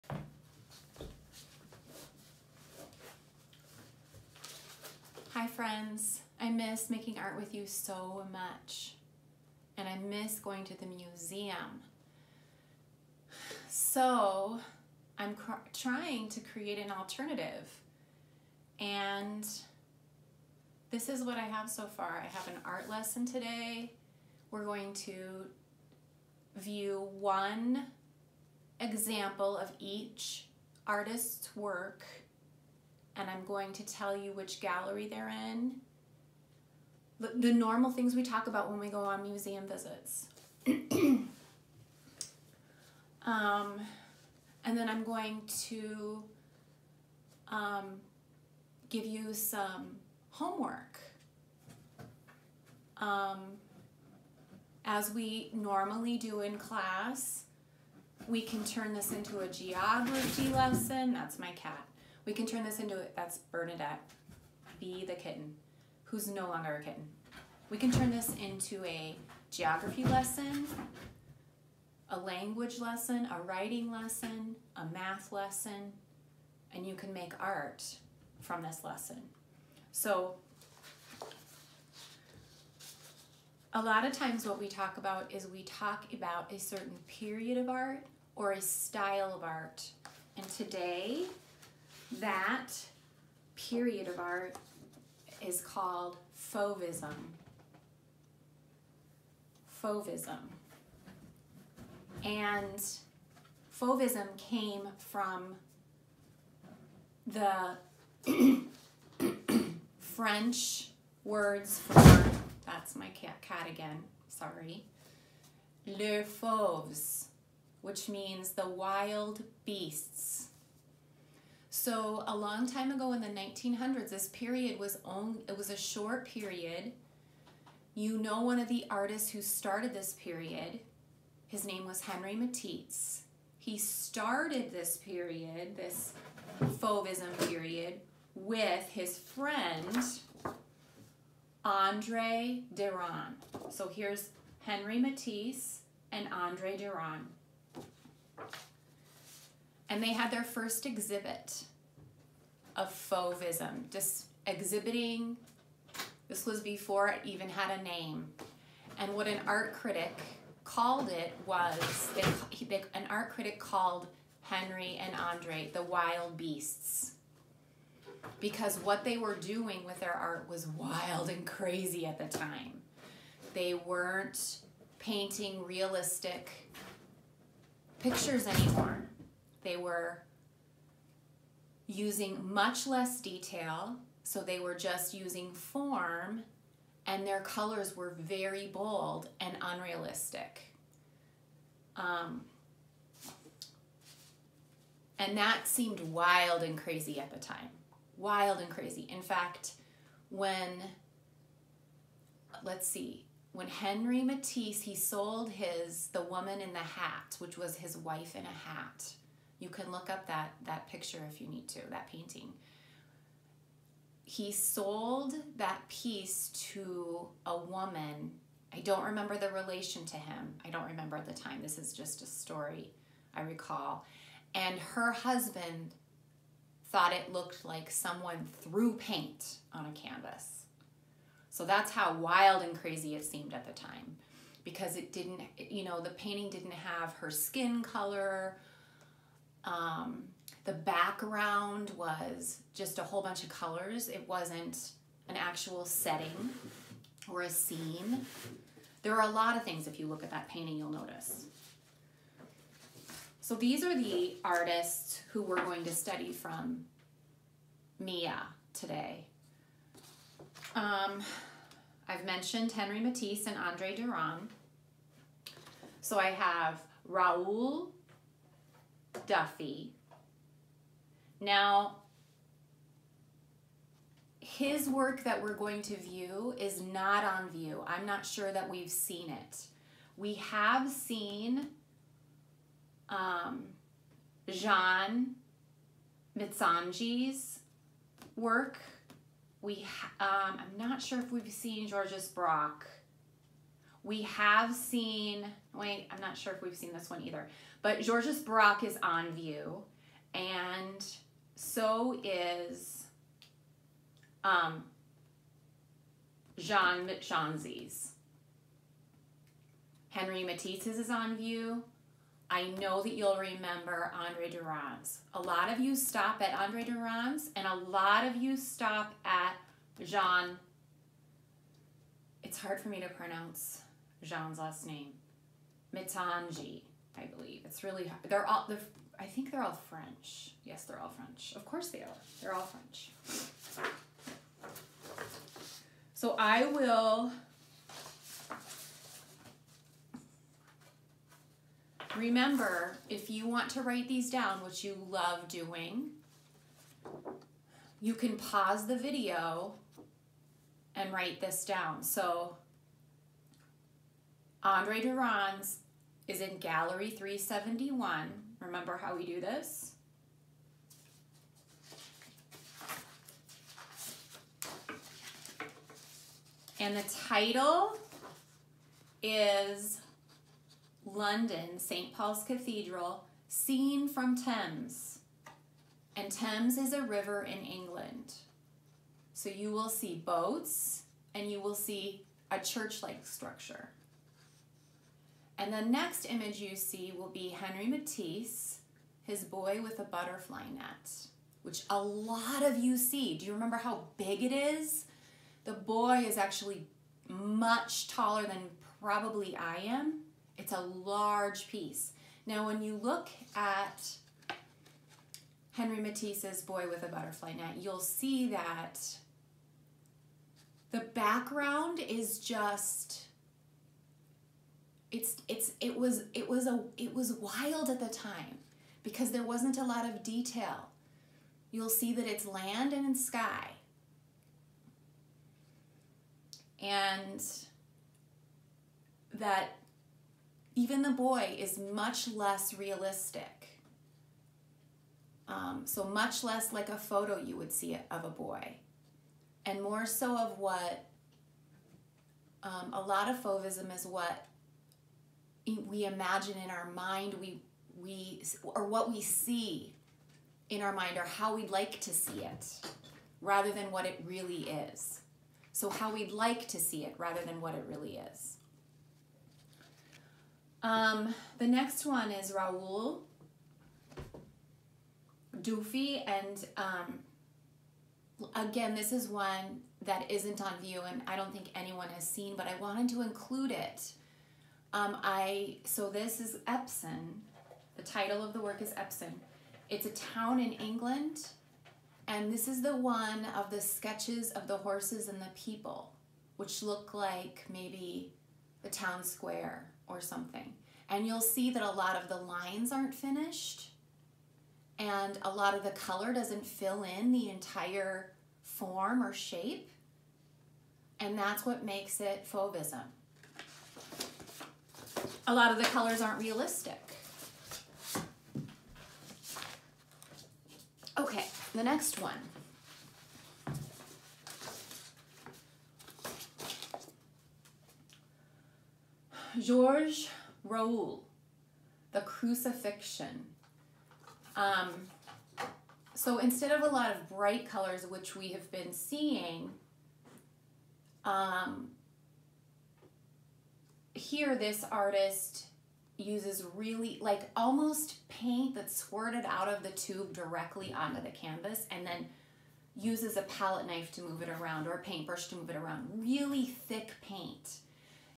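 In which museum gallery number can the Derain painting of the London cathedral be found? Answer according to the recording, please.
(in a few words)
371.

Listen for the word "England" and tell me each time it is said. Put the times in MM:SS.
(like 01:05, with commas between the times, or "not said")
06:17, 08:00.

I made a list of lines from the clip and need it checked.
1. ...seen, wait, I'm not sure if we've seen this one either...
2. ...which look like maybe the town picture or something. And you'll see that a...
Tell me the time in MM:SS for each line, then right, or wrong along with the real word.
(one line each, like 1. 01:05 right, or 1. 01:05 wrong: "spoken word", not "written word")
1. 04:54 right
2. 08:06 wrong: "square", not "picture".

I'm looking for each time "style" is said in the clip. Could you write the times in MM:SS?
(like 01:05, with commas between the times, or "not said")
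01:28.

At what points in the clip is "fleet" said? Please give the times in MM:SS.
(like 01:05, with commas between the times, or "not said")
not said.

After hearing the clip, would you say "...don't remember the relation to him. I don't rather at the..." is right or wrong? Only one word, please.
wrong.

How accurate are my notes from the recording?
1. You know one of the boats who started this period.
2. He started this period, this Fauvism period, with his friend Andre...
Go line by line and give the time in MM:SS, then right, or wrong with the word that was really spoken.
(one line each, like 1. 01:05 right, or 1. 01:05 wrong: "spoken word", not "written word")
1. 02:07 wrong: "artists", not "boats"
2. 02:13 right.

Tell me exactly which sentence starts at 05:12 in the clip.
I know that you'll remember Andre Derain's.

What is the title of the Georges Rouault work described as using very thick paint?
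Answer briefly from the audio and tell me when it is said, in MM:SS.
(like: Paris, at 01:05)
The Crucifixion, at 08:42.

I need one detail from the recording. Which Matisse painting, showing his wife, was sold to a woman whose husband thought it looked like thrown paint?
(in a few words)
The Woman in the Hat.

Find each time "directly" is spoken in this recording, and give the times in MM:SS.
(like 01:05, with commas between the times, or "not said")
09:00.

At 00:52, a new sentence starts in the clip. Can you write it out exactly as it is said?
Um, as we normally do in class, we can turn this into a geography lesson.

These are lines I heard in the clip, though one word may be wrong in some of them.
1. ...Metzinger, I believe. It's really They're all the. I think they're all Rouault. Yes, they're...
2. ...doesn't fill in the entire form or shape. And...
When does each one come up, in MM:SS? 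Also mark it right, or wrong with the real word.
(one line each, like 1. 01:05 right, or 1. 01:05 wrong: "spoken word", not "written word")
1. 05:25 wrong: "French", not "Rouault"
2. 08:16 right.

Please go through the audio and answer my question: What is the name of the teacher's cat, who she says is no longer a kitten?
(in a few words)
Bernadette.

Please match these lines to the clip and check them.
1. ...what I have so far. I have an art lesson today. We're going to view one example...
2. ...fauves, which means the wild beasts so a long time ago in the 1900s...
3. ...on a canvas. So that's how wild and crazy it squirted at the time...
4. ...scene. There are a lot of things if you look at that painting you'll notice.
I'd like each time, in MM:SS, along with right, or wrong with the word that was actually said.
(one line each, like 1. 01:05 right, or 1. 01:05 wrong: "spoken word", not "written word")
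1. 00:21 right
2. 01:56 right
3. 03:49 wrong: "seemed", not "squirted"
4. 04:07 right.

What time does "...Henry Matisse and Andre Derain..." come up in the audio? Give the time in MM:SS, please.
02:24.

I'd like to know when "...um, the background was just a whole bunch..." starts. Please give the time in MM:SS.
03:59.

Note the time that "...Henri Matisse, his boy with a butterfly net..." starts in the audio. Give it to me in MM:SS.
06:27.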